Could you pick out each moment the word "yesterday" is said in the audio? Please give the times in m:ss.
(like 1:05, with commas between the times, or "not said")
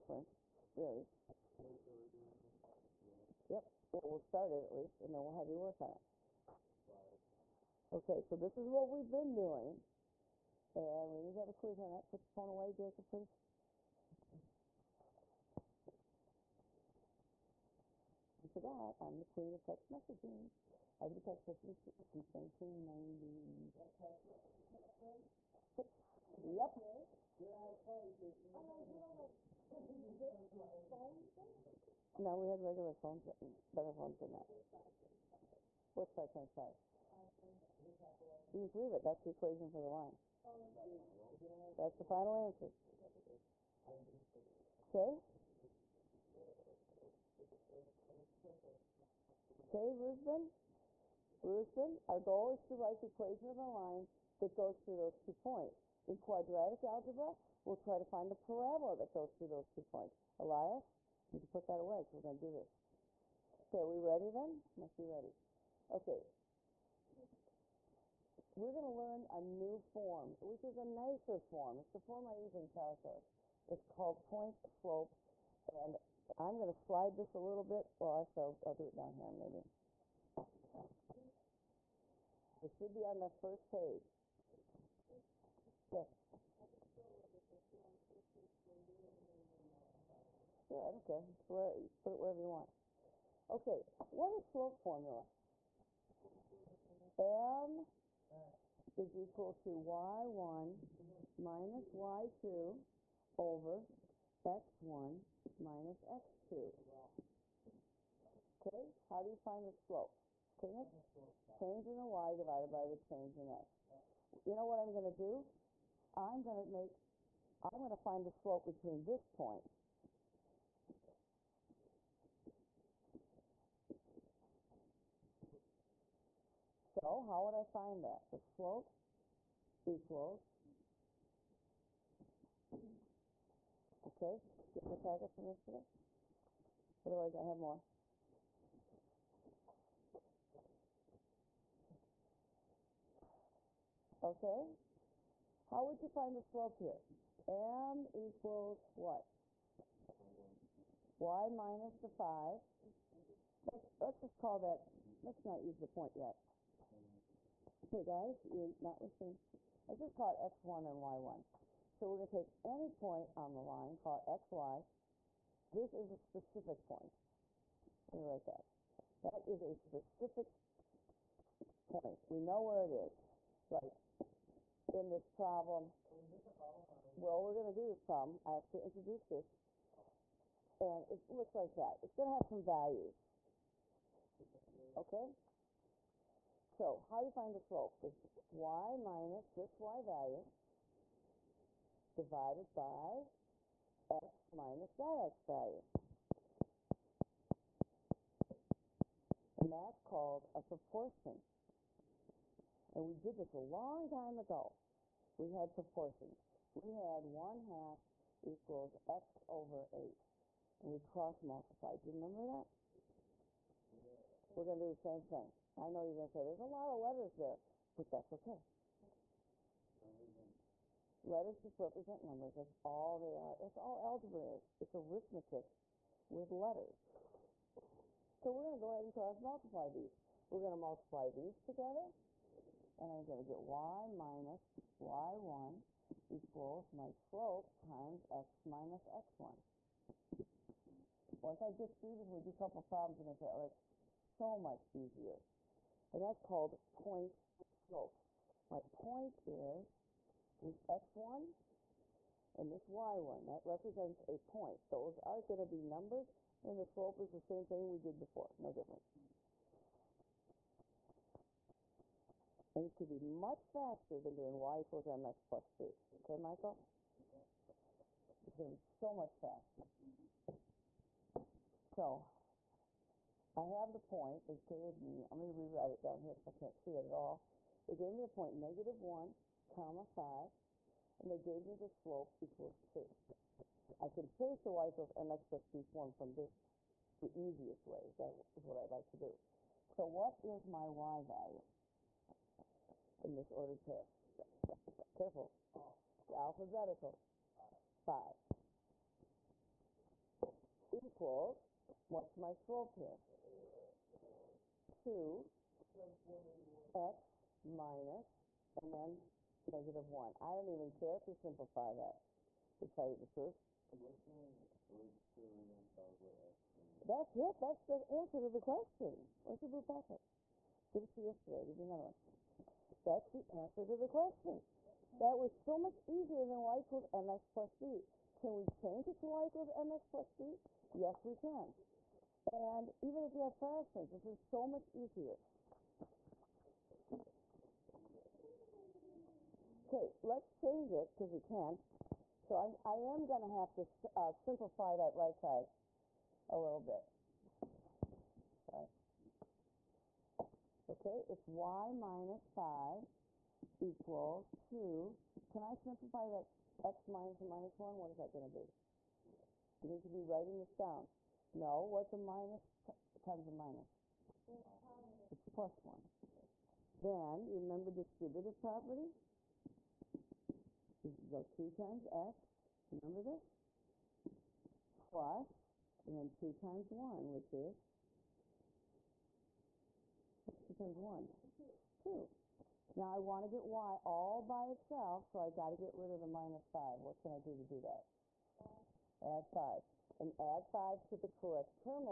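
2:15, 5:21.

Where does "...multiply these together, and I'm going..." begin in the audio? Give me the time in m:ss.
3:50.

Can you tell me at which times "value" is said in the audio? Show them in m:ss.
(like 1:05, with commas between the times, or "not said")
3:02, 3:10, 3:15, 4:51.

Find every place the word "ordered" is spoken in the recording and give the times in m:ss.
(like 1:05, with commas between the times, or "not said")
4:53.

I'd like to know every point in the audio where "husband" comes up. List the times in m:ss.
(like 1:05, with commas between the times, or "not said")
not said.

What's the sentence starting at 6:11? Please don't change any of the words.
You go 2 times x, remember this?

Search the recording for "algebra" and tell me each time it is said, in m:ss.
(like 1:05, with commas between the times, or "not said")
0:56, 3:44.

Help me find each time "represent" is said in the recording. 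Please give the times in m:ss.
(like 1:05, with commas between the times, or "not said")
3:41, 4:13.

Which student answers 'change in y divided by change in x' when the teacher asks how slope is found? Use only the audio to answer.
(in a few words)
Nick.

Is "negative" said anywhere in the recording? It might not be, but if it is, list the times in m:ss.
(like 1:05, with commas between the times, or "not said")
4:38, 5:09.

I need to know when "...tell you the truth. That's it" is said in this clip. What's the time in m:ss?
5:12.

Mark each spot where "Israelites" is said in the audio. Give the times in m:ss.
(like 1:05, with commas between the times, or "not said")
not said.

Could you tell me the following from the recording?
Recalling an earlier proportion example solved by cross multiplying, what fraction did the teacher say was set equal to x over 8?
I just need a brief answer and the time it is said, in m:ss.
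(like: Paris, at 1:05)
1/2, at 3:27.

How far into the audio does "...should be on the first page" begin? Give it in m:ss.
1:22.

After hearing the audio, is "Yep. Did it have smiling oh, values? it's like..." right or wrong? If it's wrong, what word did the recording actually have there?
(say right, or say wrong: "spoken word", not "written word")
wrong: "faces", not "values".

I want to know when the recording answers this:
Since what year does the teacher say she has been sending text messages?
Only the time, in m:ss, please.
0:22.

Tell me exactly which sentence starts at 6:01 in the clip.
No, what's a minus times a minus?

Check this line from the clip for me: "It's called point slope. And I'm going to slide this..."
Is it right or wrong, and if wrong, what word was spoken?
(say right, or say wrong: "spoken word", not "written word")
right.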